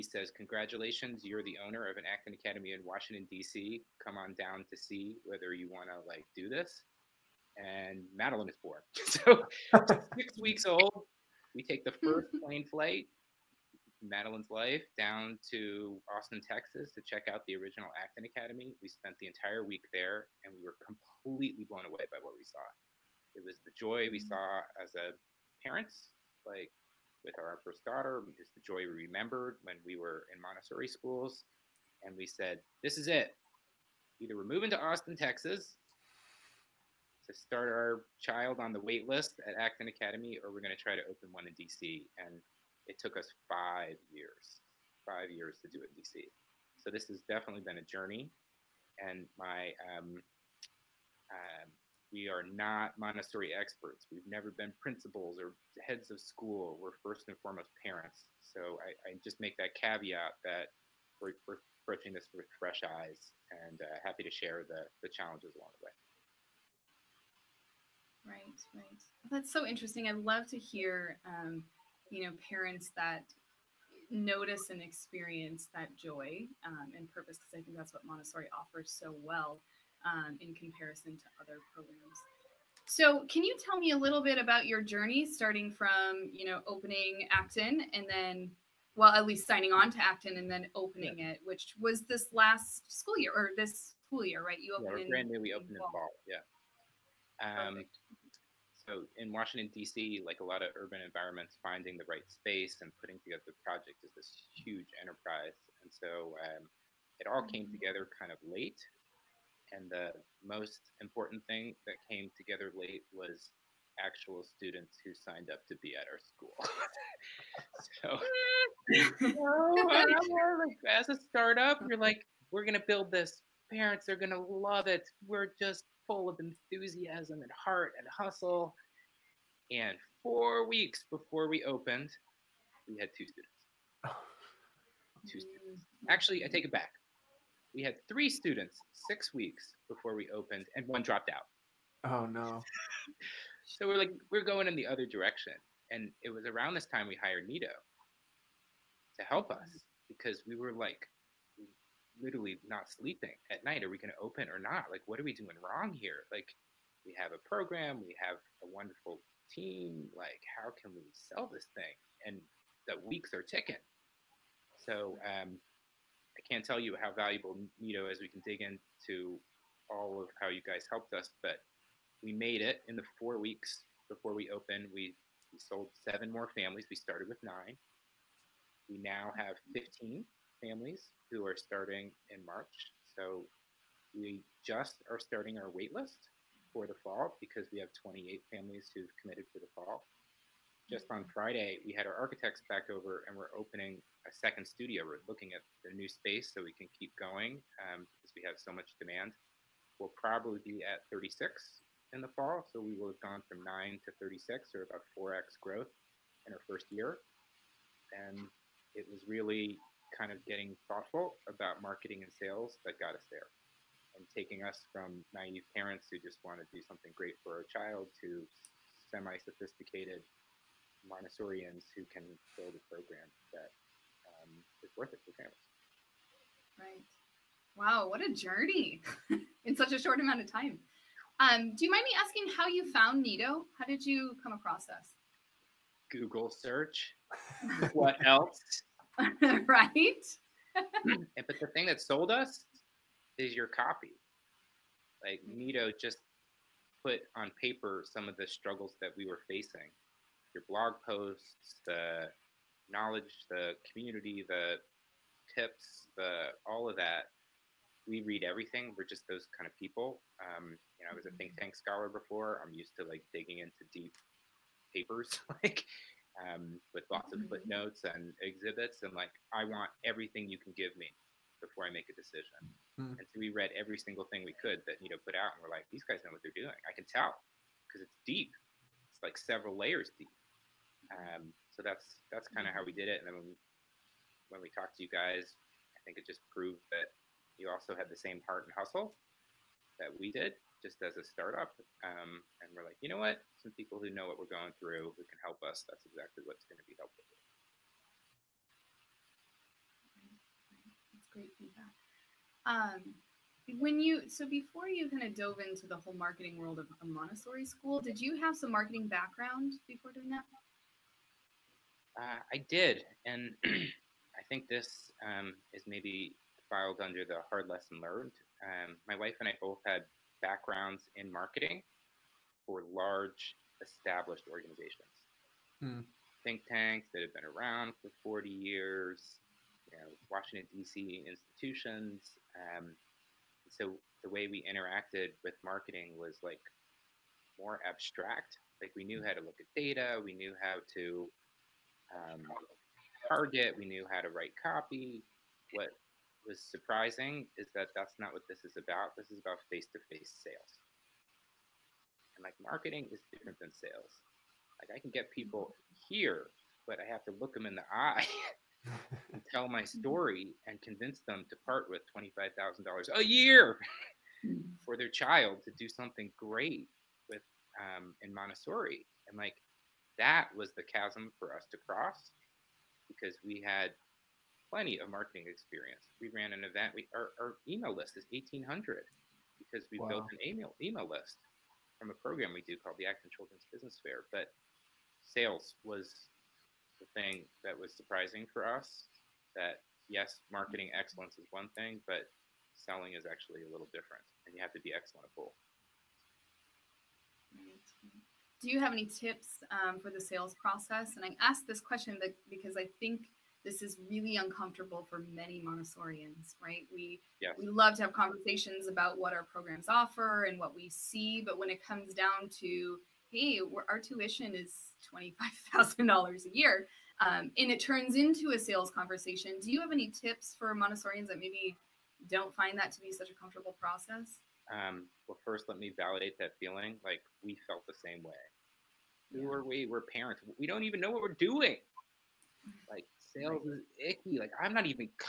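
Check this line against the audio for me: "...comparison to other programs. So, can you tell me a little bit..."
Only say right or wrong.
right.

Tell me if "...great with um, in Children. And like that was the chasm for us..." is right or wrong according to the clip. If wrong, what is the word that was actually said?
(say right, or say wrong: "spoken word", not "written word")
wrong: "Montessori", not "Children".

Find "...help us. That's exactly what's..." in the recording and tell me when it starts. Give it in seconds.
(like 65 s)
295 s.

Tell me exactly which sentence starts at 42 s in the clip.
And it took us five years, five years to do it in DC.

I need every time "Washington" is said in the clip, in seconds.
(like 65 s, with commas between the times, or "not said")
2 s, 99 s, 330 s.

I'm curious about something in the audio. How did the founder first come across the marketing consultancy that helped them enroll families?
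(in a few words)
Google search.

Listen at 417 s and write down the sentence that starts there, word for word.
Um, and it turns into a sales conversation.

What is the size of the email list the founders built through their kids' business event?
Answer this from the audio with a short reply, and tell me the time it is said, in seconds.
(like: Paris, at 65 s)
1,800, at 378 s.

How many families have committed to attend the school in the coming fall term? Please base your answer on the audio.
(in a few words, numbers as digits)
28.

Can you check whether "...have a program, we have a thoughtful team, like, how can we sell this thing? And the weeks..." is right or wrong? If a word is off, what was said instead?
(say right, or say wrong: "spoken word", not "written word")
wrong: "wonderful", not "thoughtful".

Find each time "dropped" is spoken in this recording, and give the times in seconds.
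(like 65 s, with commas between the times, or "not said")
141 s.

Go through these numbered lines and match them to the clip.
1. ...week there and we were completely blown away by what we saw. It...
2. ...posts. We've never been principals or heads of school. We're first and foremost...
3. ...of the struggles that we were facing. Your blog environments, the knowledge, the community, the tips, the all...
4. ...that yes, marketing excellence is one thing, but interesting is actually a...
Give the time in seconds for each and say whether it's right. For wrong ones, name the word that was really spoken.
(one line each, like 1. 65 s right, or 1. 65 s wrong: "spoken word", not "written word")
1. 19 s right
2. 53 s wrong: "experts", not "posts"
3. 248 s wrong: "posts", not "environments"
4. 389 s wrong: "selling", not "interesting".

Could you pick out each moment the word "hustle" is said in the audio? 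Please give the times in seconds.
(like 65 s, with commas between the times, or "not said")
128 s, 288 s.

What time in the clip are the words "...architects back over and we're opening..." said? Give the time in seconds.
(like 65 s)
192 s.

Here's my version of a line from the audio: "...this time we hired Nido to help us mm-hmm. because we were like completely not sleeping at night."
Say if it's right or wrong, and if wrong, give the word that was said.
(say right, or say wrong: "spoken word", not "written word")
wrong: "literally", not "completely".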